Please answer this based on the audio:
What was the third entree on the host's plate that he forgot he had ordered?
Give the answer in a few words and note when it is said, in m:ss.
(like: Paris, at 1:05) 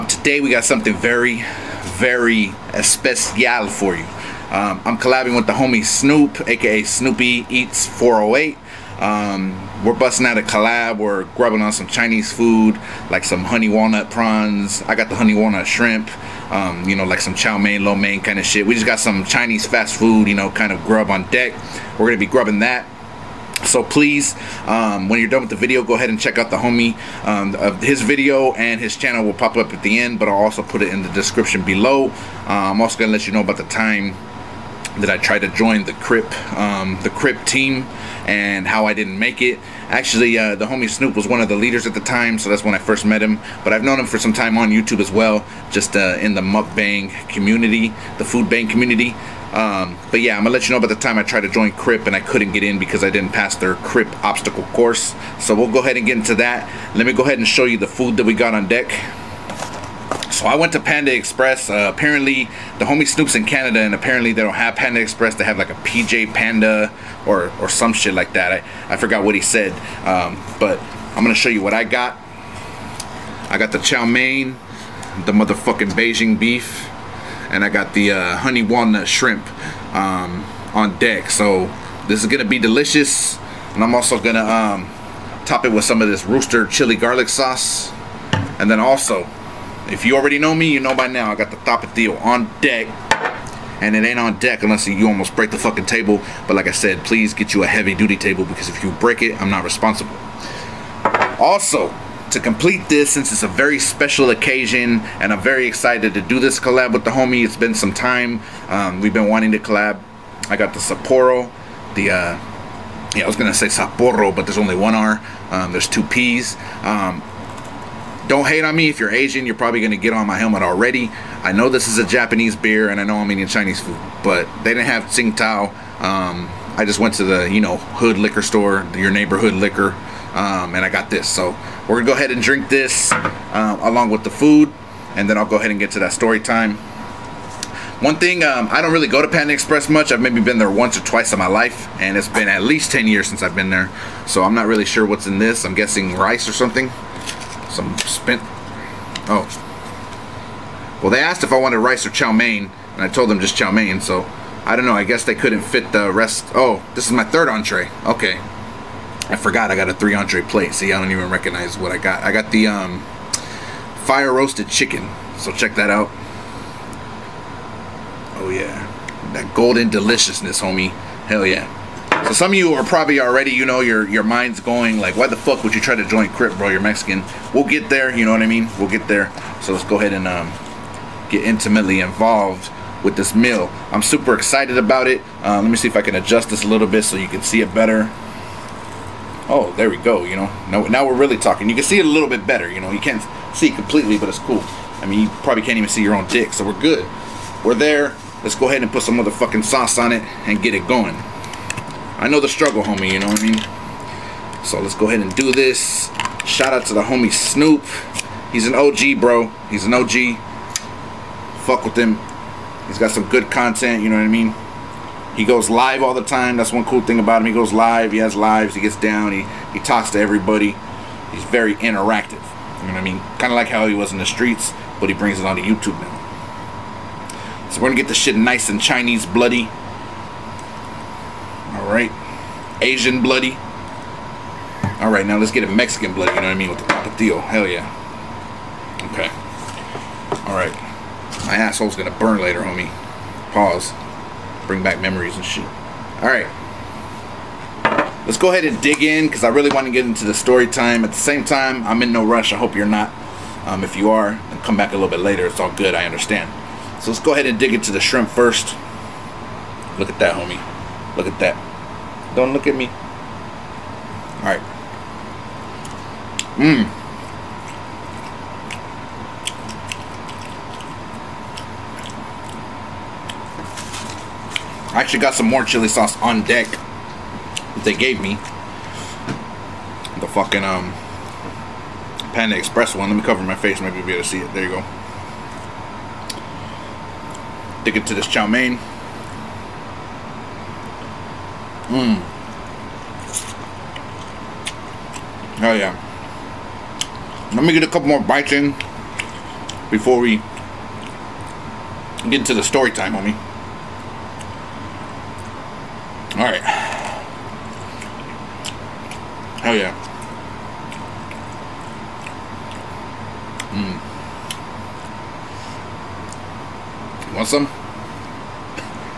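fire roasted chicken, at 2:44.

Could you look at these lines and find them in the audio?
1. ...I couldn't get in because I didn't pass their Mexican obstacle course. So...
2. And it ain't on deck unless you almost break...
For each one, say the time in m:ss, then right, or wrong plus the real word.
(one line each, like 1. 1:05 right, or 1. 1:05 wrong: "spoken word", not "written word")
1. 0:52 wrong: "Crip", not "Mexican"
2. 1:33 right.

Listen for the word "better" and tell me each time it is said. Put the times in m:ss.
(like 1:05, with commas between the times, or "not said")
3:07, 3:12.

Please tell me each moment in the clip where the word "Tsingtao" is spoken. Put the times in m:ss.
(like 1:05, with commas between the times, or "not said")
2:05.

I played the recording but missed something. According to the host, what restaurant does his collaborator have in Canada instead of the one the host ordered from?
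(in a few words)
PJ Panda.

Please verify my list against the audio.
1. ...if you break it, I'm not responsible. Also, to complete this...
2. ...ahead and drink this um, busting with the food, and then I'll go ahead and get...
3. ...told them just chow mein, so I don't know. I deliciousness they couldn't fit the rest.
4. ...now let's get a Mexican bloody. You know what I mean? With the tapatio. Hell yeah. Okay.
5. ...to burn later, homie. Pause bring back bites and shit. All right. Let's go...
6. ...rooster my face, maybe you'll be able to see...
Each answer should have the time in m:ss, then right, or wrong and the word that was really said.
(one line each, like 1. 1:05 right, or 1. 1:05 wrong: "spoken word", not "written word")
1. 1:38 right
2. 2:12 wrong: "along", not "busting"
3. 2:33 wrong: "guess", not "deliciousness"
4. 3:55 right
5. 4:02 wrong: "memories", not "bites"
6. 4:43 wrong: "cover", not "rooster".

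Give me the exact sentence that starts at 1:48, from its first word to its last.
Um, we've been wanting to collab.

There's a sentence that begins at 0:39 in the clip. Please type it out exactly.
Actually, uh, the homie Snoop was one of the leaders at the time, so that's when I first met him.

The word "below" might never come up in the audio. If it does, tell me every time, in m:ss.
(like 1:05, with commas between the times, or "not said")
0:31.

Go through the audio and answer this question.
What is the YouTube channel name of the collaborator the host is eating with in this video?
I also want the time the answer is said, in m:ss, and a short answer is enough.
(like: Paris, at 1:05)
Snoopy Eats 408, at 0:06.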